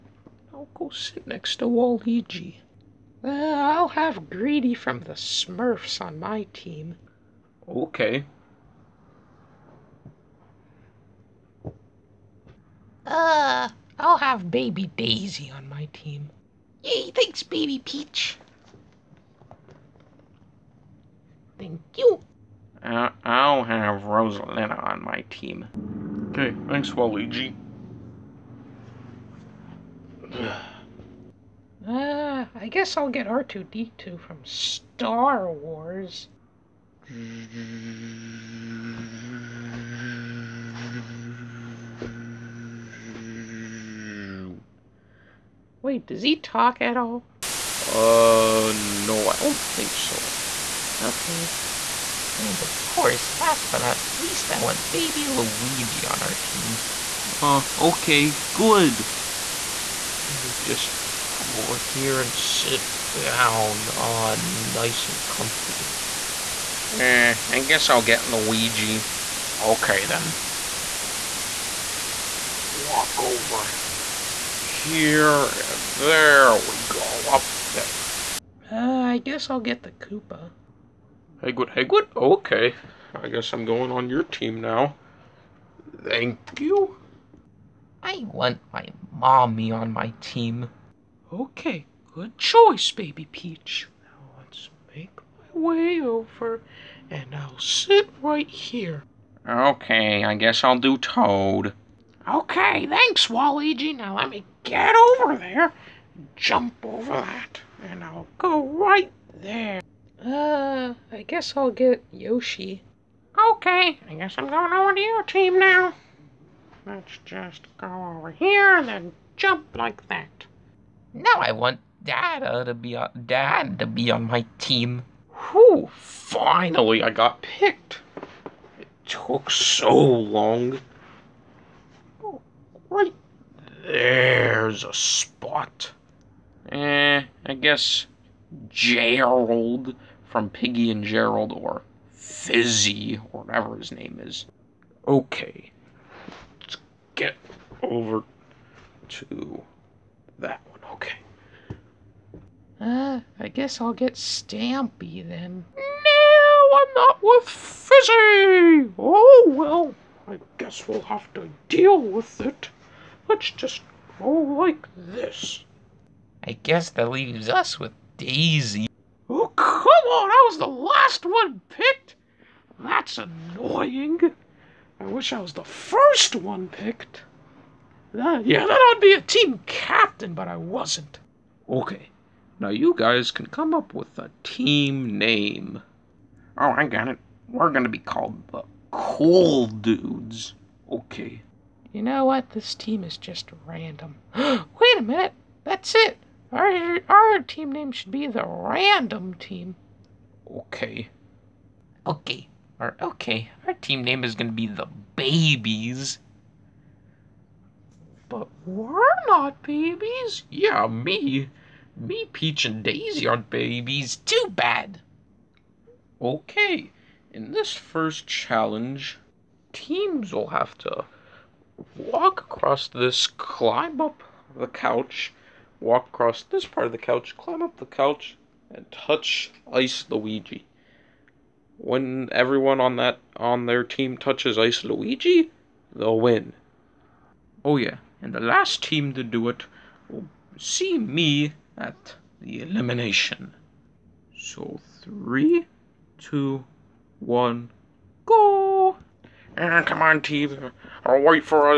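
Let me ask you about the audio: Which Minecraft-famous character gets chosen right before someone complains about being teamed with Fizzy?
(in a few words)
Stampy.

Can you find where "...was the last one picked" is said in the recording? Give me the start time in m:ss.
2:50.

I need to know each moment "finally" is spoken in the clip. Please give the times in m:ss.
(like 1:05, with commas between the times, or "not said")
2:05.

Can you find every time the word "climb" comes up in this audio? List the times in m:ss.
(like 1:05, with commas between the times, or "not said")
3:43, 3:47.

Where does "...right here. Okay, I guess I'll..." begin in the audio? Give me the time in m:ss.
1:38.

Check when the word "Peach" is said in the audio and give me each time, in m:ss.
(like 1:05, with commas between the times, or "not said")
0:17, 1:33, 3:32.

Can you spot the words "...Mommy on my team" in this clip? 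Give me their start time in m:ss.
1:29.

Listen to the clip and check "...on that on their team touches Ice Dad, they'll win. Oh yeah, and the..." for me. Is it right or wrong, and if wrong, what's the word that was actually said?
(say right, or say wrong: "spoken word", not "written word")
wrong: "Luigi", not "Dad".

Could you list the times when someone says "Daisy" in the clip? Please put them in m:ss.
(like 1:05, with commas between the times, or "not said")
0:14, 2:48, 3:32.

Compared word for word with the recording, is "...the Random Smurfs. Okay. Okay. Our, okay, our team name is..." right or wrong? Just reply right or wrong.
wrong.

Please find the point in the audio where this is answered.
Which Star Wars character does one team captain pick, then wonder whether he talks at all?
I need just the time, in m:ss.
0:33.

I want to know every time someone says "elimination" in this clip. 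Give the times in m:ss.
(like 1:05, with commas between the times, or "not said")
4:02.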